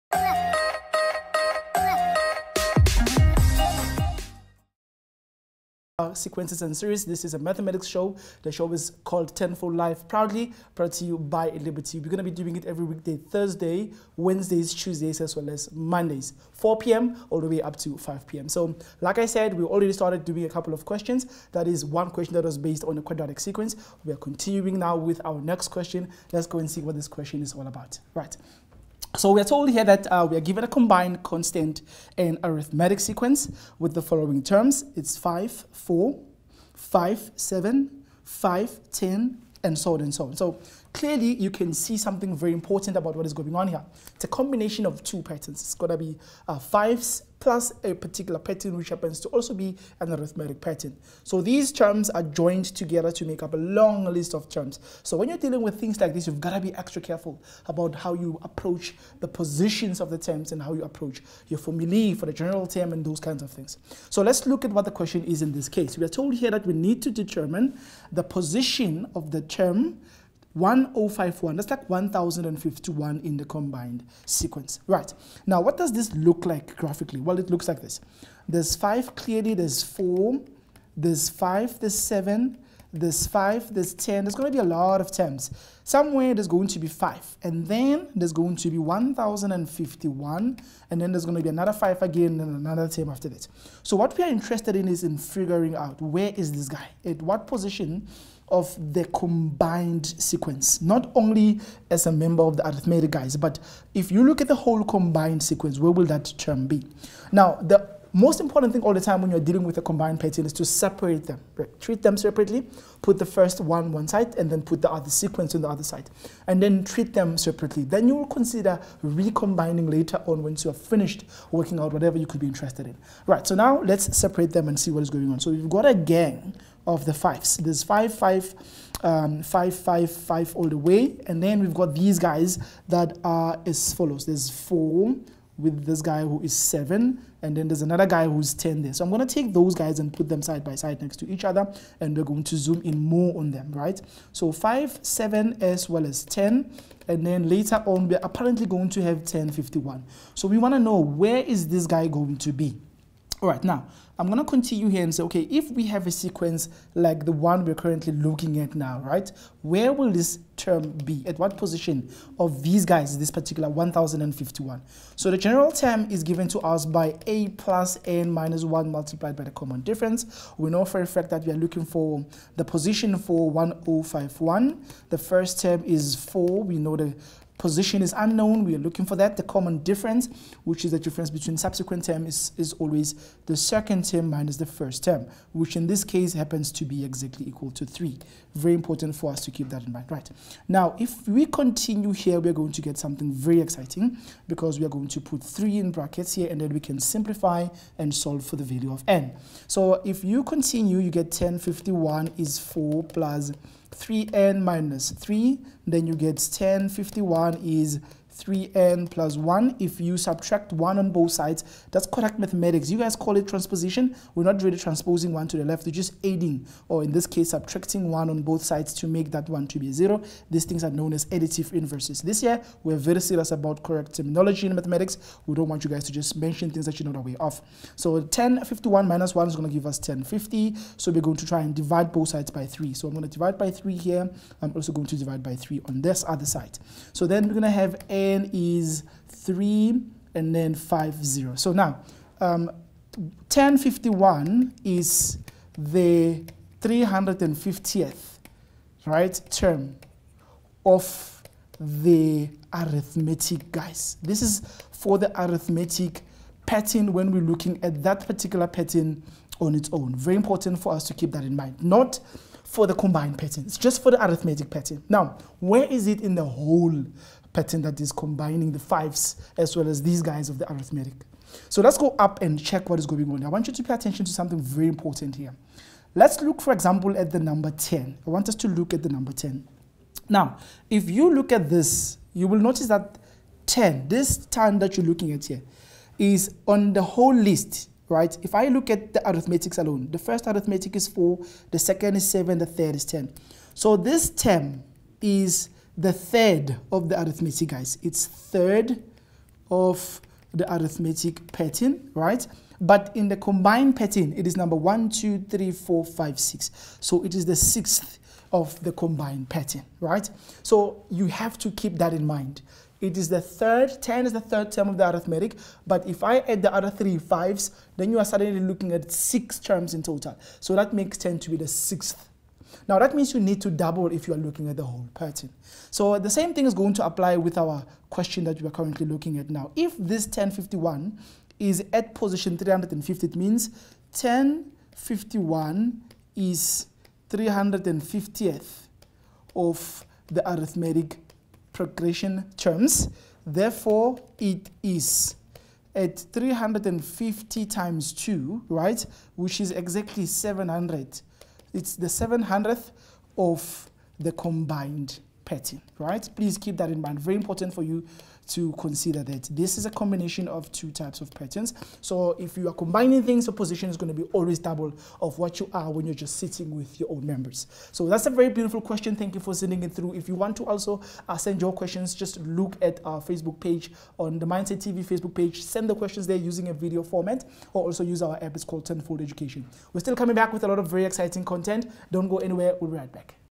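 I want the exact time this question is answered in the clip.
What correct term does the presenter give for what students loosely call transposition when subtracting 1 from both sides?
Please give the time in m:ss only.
3:41.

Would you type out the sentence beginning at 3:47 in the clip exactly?
So 1051 minus 1 is going to give us 1050.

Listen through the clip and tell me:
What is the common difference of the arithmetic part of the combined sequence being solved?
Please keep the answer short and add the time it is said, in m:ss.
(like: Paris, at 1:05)
3, at 3:07.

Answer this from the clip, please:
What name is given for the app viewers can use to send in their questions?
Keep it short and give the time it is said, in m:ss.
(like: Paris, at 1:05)
Tenfold Education, at 6:18.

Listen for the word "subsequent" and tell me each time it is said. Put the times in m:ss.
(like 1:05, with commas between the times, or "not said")
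3:01.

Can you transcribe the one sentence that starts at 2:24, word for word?
So five, seven, as well as 10, and then later on, we're apparently going to have 10, 51.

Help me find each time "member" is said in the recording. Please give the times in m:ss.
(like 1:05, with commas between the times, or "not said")
1:42, 6:07.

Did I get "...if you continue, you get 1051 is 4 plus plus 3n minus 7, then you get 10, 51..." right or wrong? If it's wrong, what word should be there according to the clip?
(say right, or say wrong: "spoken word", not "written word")
wrong: "3", not "7".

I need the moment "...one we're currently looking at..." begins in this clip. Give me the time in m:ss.
2:37.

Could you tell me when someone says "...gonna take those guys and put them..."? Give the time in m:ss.
2:19.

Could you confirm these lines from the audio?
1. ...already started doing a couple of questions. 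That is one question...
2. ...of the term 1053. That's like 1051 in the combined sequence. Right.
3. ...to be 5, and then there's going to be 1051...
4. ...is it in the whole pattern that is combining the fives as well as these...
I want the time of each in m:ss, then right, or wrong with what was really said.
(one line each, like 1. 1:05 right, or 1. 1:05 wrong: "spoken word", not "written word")
1. 0:19 right
2. 1:09 wrong: "1051", not "1053"
3. 1:26 right
4. 4:25 right.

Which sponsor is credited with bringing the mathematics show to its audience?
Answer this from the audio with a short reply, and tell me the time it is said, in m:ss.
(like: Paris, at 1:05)
Liberty, at 0:11.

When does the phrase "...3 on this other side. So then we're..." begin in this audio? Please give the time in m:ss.
3:55.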